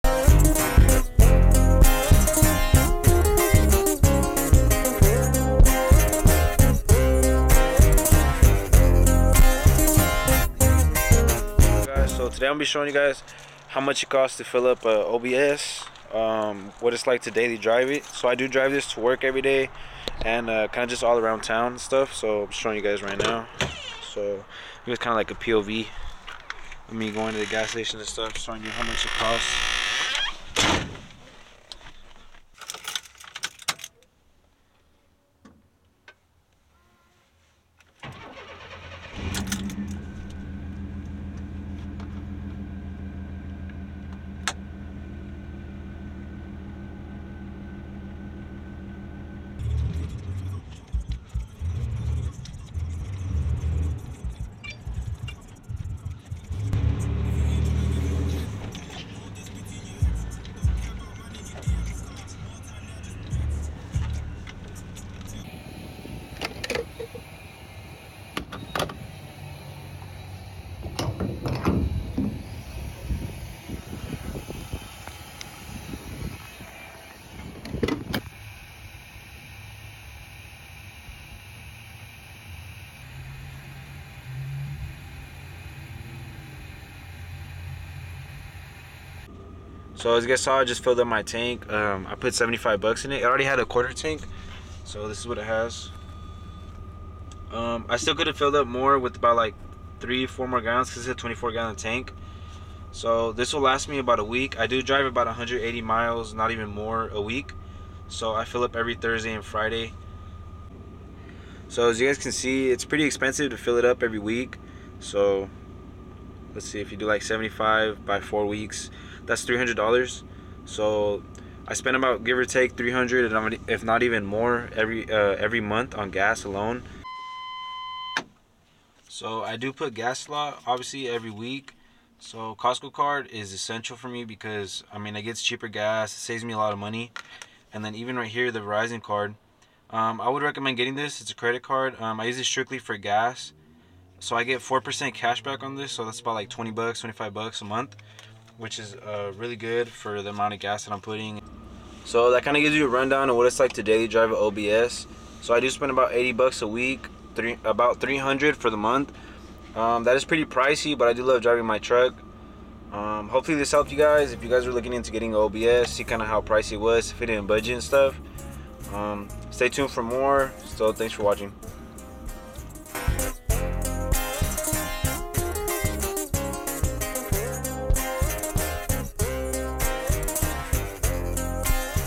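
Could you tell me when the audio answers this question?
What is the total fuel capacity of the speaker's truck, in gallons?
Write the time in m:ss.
1:41.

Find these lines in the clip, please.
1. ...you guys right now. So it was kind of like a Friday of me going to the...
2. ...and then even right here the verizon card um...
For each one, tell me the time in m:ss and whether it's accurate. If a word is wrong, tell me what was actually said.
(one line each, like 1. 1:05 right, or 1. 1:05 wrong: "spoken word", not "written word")
1. 0:22 wrong: "POV", not "Friday"
2. 2:17 right.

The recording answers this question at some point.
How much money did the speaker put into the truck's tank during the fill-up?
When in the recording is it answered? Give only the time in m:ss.
1:32.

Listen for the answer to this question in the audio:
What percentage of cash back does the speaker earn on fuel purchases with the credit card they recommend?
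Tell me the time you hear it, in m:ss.
2:24.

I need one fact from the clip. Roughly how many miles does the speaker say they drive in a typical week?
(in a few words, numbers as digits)
180 miles.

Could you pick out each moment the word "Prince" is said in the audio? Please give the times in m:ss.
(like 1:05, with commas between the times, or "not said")
not said.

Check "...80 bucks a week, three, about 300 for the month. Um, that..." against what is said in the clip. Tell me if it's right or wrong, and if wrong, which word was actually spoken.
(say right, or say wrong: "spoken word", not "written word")
right.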